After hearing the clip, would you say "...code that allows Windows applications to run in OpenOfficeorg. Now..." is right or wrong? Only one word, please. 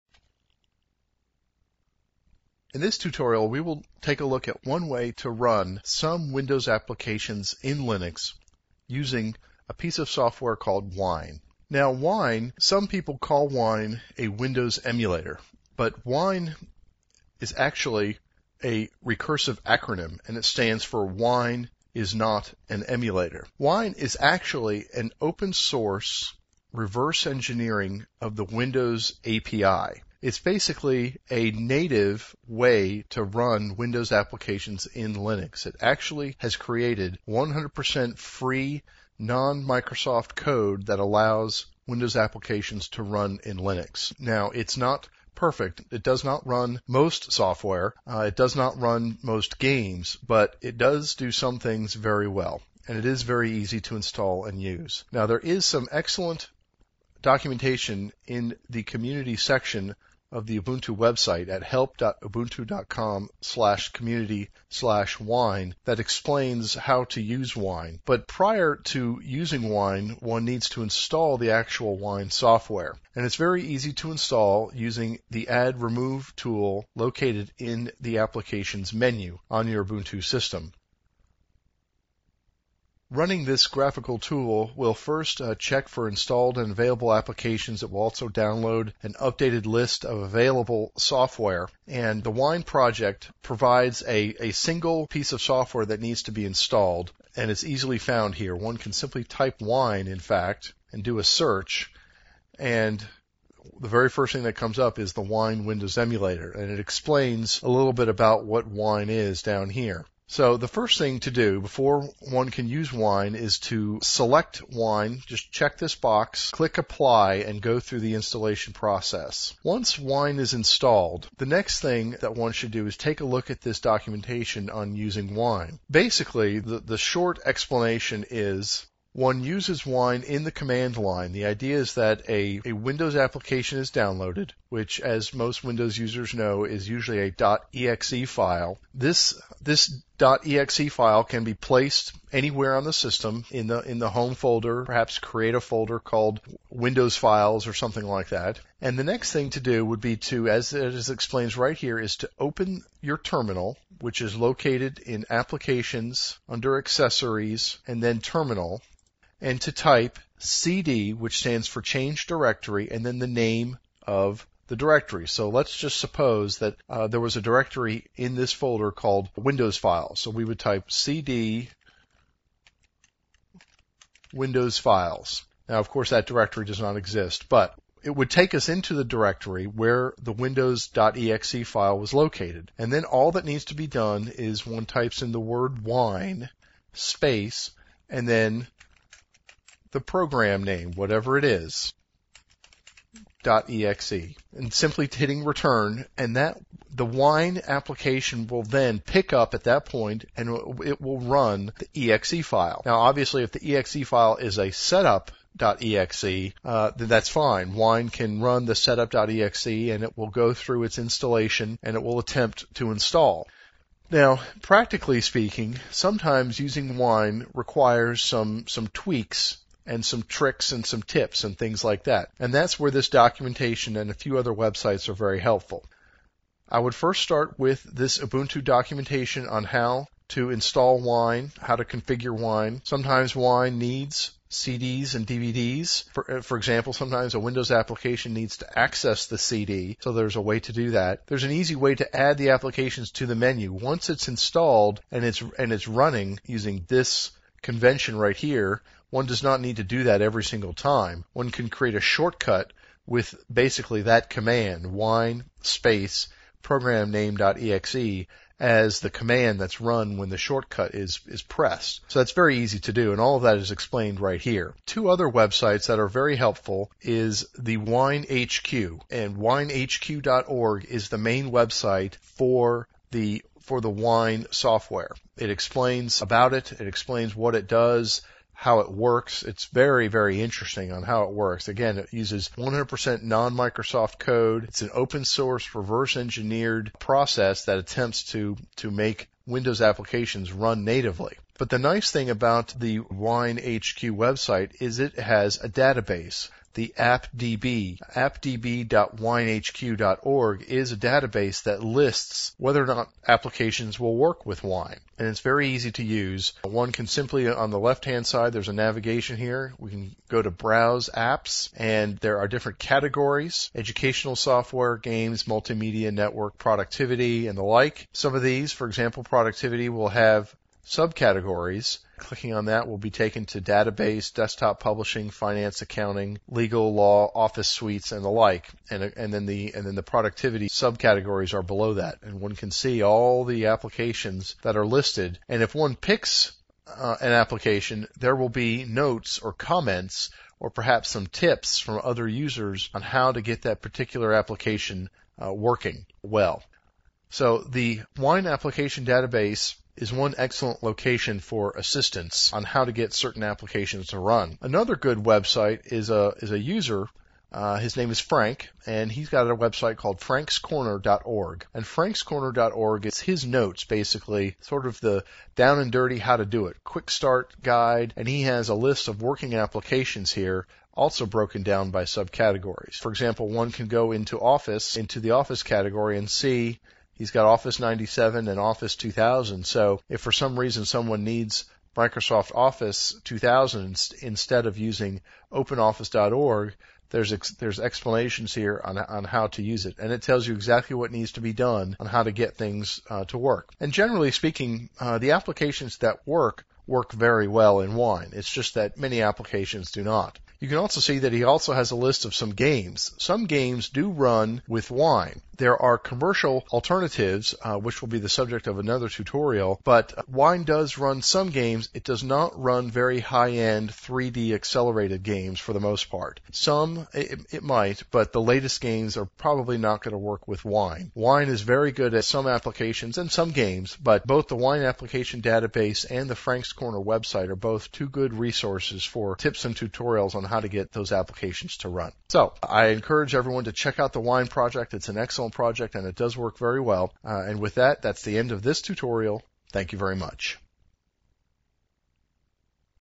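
wrong.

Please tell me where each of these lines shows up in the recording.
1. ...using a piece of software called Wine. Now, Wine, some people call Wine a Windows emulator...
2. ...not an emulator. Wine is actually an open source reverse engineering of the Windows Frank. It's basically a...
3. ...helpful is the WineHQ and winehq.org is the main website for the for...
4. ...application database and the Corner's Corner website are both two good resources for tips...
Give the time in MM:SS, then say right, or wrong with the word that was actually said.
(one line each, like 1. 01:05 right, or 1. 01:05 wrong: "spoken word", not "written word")
1. 00:08 right
2. 00:22 wrong: "API", not "Frank"
3. 04:26 right
4. 07:04 wrong: "Frank", not "Corner".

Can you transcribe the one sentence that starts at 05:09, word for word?
We can go to browse apps and there are different categories, educational software, games, multimedia, network, productivity, and the like.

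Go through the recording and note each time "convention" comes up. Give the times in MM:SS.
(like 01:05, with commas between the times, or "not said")
04:07.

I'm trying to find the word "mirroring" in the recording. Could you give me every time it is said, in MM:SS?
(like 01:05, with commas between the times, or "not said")
not said.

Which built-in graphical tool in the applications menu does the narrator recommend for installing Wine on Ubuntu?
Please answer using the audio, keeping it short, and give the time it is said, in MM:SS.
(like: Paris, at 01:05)
add remove tool, at 01:15.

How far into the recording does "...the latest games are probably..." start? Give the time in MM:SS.
06:58.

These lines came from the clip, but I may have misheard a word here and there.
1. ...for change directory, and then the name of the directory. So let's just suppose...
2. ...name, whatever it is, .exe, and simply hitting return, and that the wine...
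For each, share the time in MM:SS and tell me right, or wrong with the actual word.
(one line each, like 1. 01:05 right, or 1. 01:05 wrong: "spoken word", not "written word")
1. 02:41 right
2. 03:10 right.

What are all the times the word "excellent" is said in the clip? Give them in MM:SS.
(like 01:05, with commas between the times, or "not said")
00:55, 05:50, 07:15.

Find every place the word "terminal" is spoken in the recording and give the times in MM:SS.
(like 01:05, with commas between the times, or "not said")
02:33, 02:38.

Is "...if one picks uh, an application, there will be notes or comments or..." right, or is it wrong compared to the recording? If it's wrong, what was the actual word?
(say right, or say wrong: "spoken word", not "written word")
right.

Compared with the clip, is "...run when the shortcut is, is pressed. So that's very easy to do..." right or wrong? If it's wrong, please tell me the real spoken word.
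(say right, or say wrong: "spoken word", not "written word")
right.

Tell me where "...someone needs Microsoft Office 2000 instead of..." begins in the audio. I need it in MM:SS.
06:20.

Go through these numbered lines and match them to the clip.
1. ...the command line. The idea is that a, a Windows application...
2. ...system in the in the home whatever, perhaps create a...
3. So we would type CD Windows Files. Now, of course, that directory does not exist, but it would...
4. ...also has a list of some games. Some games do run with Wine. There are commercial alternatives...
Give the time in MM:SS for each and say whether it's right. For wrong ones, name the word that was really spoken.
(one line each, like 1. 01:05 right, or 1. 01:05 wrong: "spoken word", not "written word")
1. 02:10 right
2. 02:22 wrong: "folder", not "whatever"
3. 02:50 right
4. 06:41 right.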